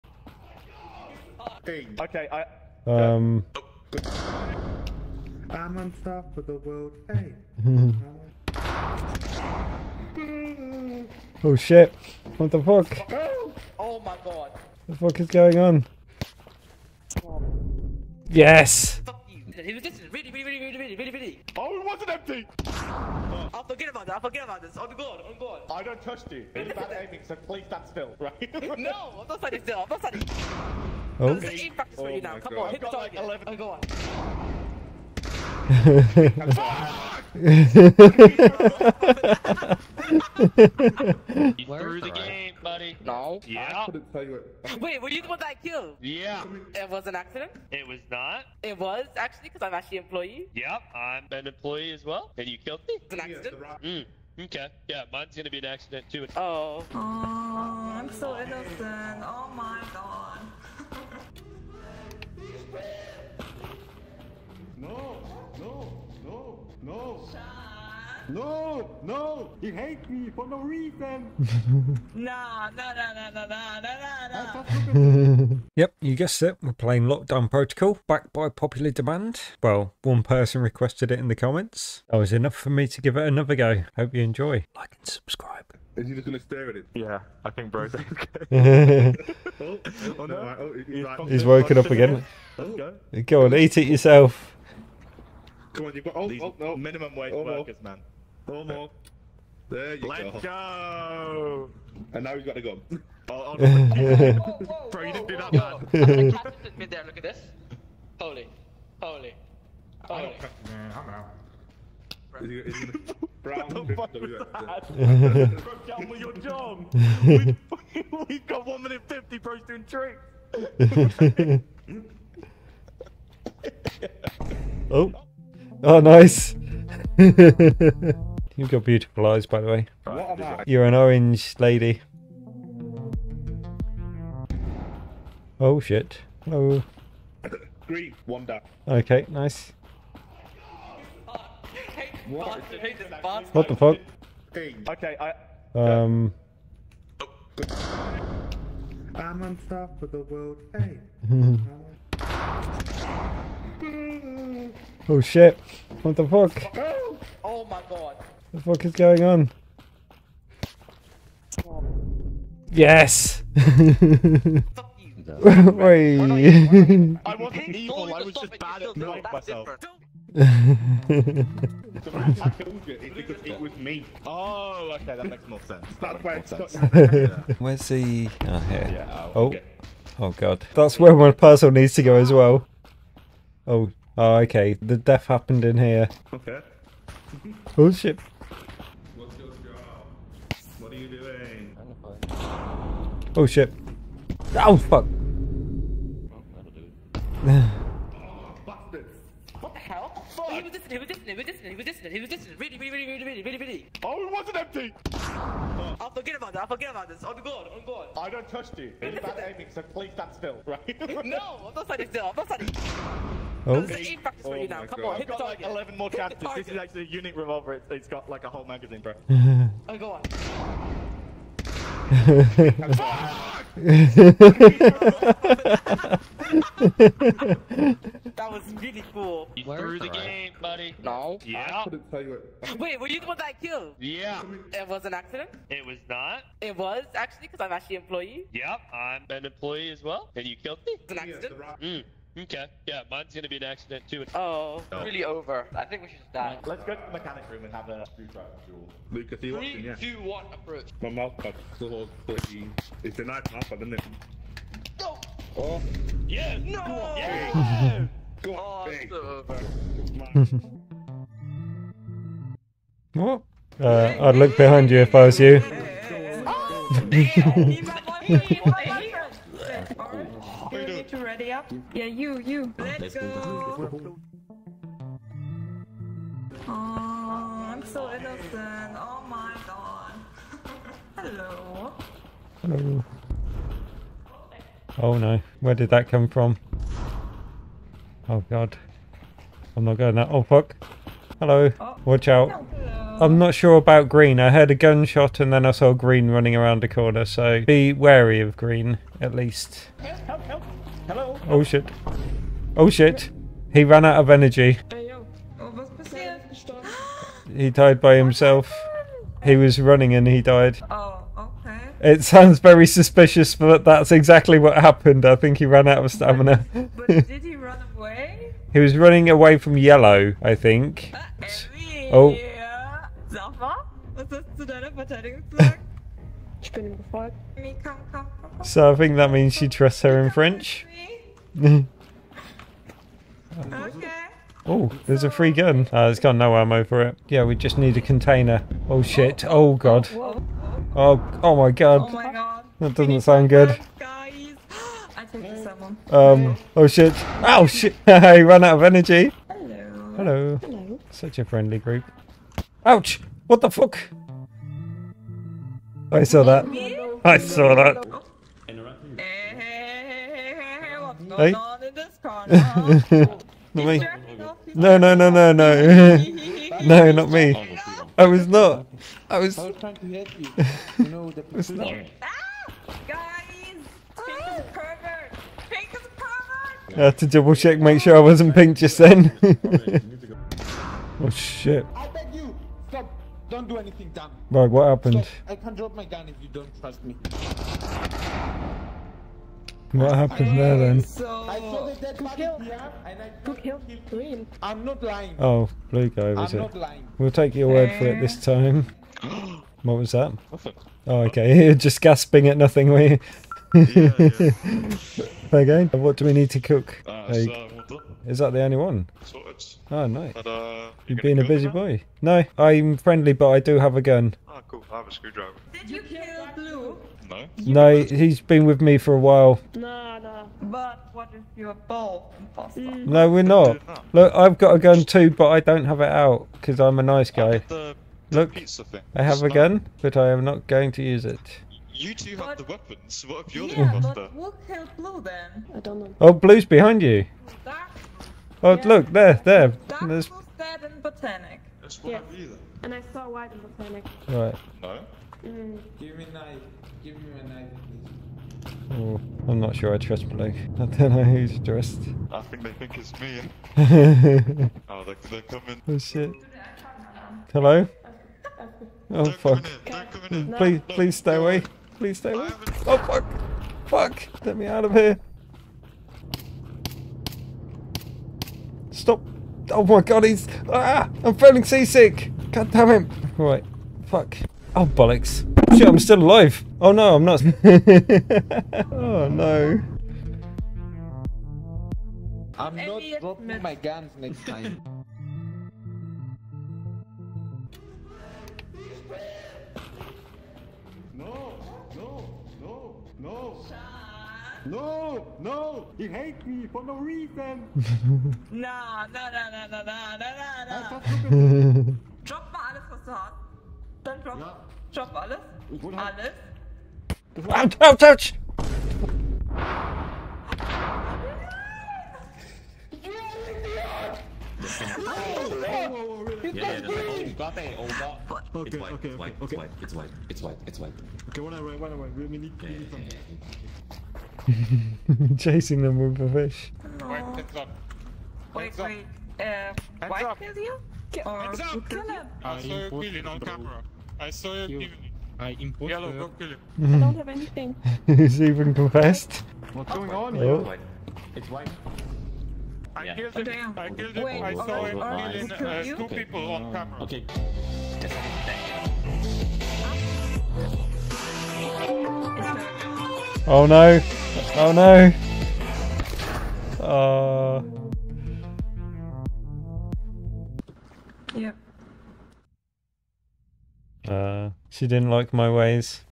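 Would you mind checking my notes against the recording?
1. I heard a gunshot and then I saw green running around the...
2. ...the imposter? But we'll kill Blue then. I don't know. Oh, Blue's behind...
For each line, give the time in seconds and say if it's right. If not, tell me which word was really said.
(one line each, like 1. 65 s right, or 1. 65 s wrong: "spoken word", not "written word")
1. 294 s right
2. 433 s right.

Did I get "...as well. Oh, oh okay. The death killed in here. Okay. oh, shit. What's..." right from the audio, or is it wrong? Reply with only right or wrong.
wrong.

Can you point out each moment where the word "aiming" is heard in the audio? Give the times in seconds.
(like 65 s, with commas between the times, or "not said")
27 s, 209 s.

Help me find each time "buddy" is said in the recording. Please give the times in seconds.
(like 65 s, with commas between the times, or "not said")
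42 s, 230 s.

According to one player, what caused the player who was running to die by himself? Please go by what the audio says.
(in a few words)
ran out of stamina.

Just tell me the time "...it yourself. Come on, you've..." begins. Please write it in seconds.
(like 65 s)
93 s.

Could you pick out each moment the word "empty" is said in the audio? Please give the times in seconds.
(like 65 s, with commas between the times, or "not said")
22 s, 204 s.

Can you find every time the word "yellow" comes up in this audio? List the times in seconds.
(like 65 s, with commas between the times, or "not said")
319 s, 535 s.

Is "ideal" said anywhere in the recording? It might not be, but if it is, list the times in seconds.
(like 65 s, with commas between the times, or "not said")
not said.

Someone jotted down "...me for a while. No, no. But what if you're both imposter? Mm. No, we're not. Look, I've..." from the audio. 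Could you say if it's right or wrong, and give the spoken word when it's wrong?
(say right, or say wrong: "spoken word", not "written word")
right.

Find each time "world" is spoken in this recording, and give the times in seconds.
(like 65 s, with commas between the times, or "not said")
6 s, 150 s.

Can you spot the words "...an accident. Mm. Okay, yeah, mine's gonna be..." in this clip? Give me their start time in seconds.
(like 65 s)
53 s.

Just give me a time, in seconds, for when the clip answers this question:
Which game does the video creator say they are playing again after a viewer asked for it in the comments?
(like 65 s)
77 s.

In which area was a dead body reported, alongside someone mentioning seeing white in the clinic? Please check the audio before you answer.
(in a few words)
Botanic.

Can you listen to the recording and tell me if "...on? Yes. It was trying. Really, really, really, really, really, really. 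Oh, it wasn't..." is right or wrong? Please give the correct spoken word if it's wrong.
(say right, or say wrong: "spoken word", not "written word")
wrong: "listening", not "trying".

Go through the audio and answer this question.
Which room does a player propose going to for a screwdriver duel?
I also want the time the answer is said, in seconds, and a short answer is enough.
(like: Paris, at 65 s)
mechanic room, at 247 s.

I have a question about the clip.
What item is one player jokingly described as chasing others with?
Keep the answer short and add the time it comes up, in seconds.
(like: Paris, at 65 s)
a fish, at 526 s.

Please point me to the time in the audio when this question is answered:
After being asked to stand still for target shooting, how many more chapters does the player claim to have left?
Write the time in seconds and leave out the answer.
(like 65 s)
215 s.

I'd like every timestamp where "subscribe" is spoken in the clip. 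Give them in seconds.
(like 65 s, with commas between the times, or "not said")
85 s.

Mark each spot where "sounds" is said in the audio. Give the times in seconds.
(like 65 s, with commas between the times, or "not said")
312 s, 343 s.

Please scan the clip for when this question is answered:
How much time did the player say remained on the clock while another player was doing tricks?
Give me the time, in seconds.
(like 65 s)
118 s.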